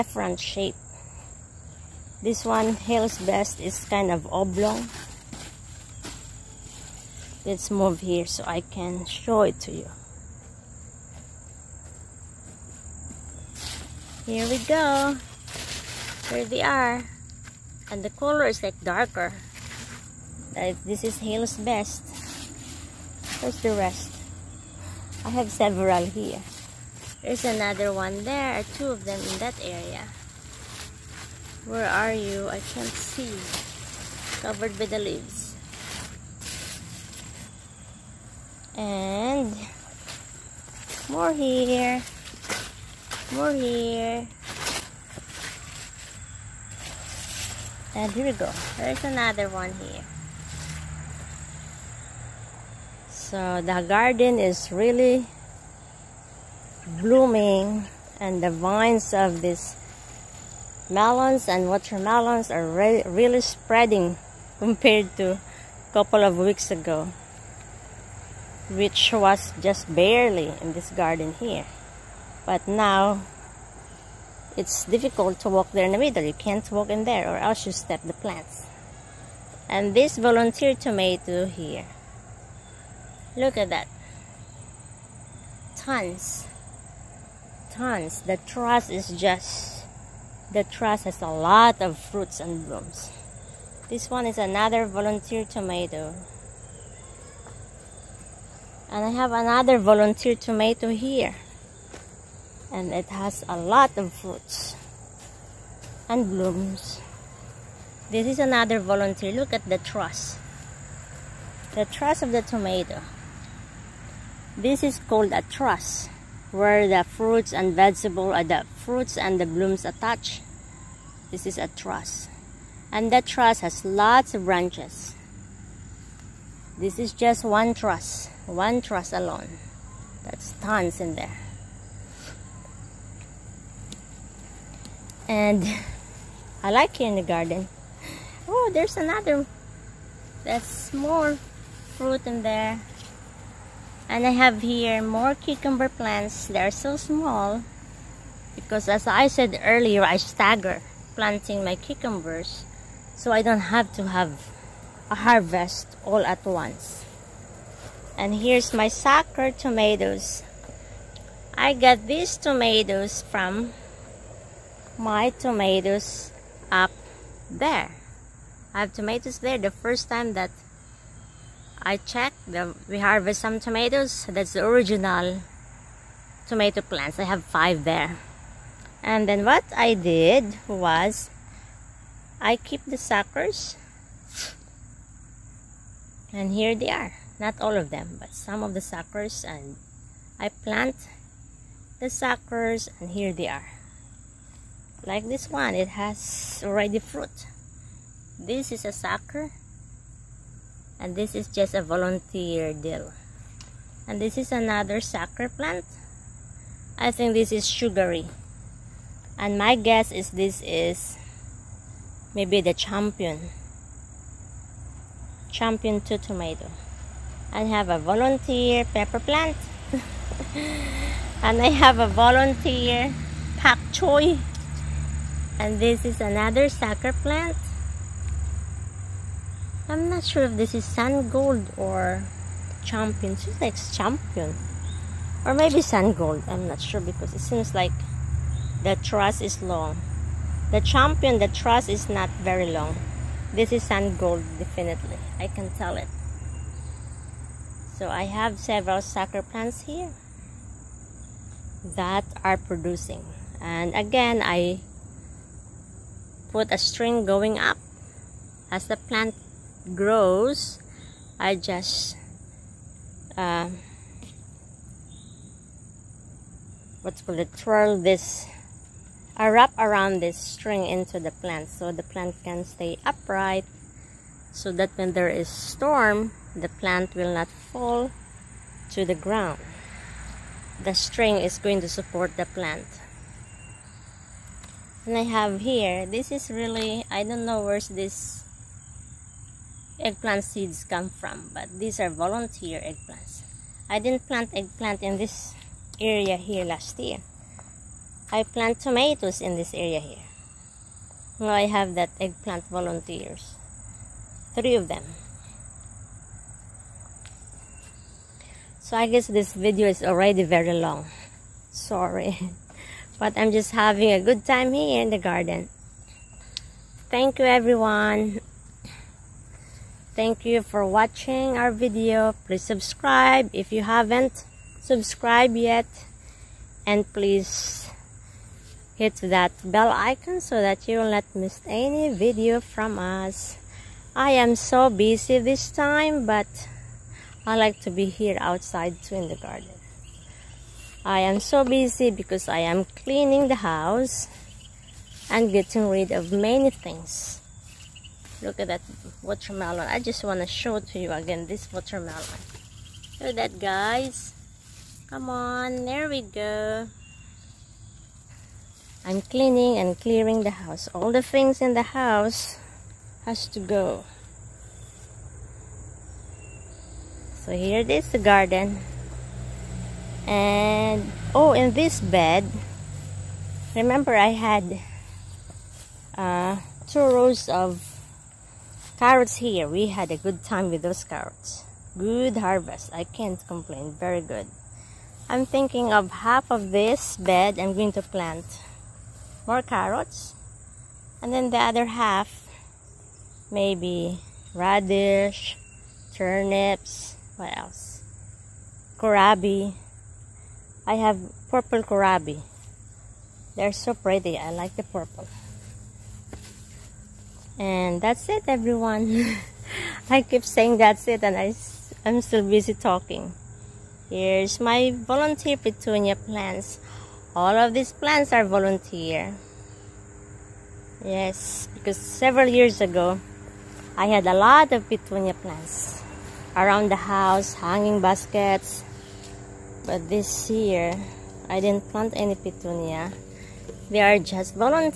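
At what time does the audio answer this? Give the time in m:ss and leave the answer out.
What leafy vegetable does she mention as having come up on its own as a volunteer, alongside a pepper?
3:42.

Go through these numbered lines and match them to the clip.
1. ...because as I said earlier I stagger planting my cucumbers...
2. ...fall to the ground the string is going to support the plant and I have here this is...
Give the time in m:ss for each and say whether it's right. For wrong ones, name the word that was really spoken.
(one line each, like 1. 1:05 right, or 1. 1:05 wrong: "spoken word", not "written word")
1. 2:28 right
2. 4:37 right.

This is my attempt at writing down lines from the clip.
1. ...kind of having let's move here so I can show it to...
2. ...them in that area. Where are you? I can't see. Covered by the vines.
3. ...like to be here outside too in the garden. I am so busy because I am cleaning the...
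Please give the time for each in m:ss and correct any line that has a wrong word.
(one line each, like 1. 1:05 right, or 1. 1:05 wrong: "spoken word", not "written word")
1. 0:03 wrong: "oblong", not "having"
2. 0:29 wrong: "leaves", not "vines"
3. 5:37 right.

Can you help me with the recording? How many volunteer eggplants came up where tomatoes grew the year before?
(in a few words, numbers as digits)
3.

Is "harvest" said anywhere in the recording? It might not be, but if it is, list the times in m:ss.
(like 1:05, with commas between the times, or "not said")
2:35, 2:52, 6:22.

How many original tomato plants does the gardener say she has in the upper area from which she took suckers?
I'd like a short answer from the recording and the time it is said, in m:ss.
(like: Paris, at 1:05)
5, at 2:57.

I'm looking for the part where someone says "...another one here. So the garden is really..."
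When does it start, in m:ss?
0:49.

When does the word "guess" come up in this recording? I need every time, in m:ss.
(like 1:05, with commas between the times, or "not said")
3:29, 5:09.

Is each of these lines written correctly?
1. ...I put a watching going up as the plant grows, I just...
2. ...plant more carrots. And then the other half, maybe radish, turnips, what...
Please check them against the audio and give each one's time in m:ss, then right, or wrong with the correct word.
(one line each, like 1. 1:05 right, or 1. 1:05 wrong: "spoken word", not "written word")
1. 4:14 wrong: "string", not "watching"
2. 6:28 right.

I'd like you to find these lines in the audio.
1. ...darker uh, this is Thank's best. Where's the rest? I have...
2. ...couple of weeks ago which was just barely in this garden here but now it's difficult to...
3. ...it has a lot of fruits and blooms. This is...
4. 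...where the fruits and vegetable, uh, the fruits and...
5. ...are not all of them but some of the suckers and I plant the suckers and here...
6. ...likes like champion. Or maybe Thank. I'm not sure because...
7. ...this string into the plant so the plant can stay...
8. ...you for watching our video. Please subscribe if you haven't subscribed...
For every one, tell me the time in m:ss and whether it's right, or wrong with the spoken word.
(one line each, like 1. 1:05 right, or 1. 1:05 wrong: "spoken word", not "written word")
1. 0:18 wrong: "Hale", not "Thank"
2. 1:05 right
3. 1:42 right
4. 1:56 right
5. 3:06 right
6. 3:53 wrong: "Sungold", not "Thank"
7. 4:30 right
8. 5:20 right.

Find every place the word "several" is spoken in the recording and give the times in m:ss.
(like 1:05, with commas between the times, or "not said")
0:25, 4:08, 7:01.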